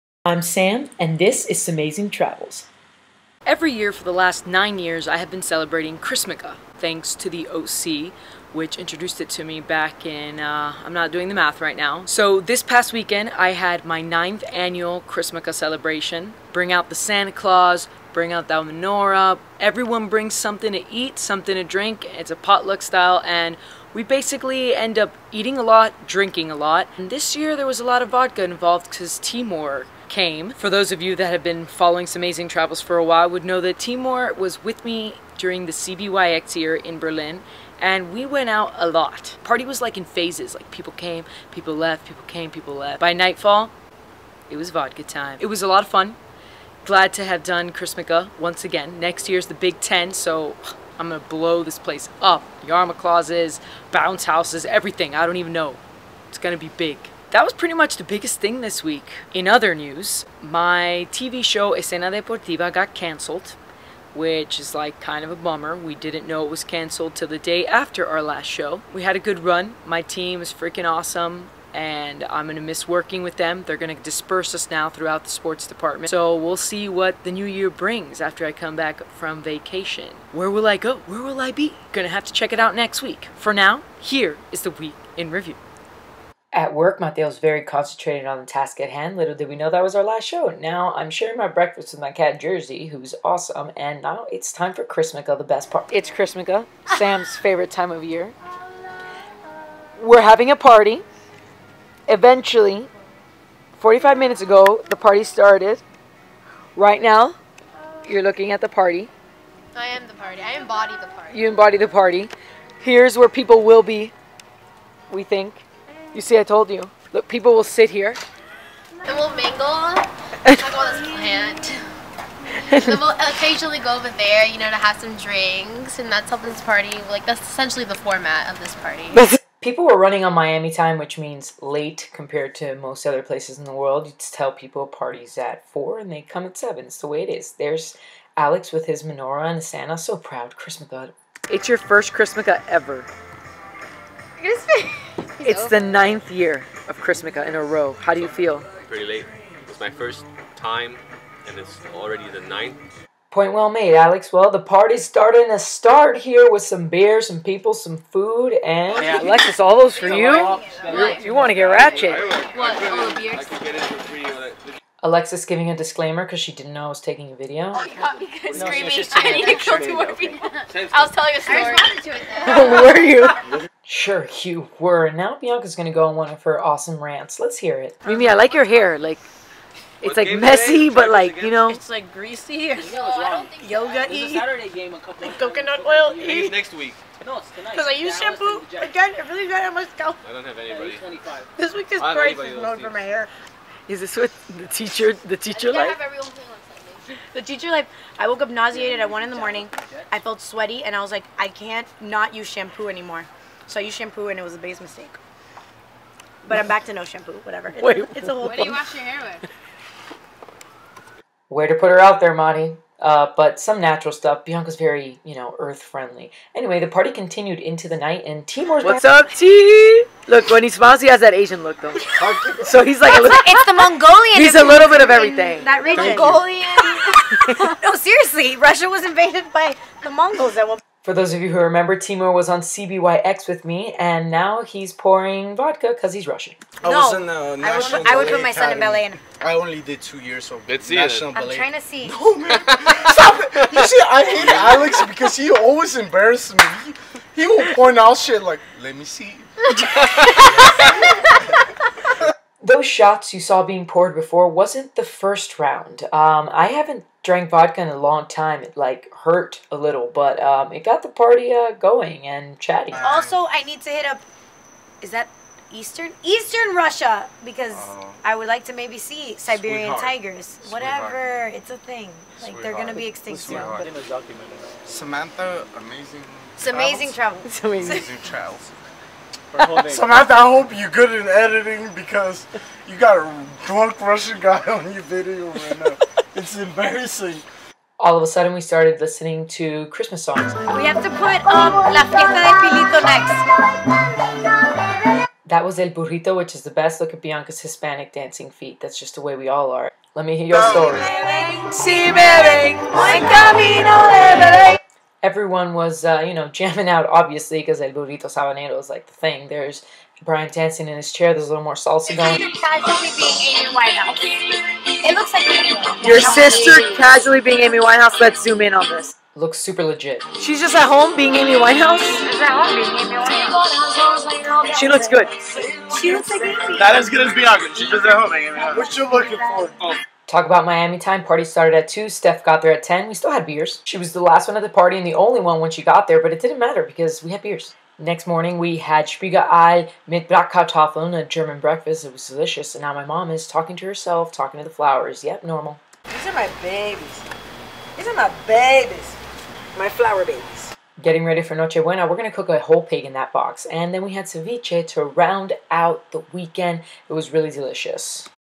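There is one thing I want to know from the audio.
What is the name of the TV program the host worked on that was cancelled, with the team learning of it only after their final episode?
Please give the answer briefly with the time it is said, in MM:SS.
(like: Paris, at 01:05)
Escena Deportiva, at 01:01.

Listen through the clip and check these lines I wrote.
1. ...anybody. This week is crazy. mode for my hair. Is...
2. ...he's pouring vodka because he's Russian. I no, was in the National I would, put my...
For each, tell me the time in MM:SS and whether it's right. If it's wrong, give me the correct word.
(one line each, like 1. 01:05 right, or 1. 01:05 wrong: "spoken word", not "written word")
1. 03:10 right
2. 03:54 right.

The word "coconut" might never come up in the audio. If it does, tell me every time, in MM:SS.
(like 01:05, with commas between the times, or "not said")
03:05.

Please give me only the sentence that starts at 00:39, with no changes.
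Party was like in phases, like people came, people left, people came, people left.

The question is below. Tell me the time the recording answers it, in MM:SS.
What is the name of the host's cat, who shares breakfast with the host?
01:32.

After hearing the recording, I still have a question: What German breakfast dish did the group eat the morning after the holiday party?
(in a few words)
Spiegelei mit Bratkartoffeln.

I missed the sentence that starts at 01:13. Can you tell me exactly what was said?
They're going to disperse us now throughout the sports department.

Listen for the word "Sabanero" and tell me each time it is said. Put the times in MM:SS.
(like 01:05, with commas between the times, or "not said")
05:08.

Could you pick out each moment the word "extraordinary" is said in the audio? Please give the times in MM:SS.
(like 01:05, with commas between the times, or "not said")
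not said.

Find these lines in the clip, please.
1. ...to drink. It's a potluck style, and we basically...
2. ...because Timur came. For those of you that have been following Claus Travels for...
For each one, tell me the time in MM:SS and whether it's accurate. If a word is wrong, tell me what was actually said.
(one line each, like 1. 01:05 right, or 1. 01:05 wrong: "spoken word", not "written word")
1. 00:21 right
2. 00:28 wrong: "Samazing", not "Claus".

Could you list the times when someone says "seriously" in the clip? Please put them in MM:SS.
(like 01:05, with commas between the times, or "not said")
03:47.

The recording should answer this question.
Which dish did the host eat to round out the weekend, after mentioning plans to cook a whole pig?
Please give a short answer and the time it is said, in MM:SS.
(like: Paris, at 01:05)
ceviche, at 05:54.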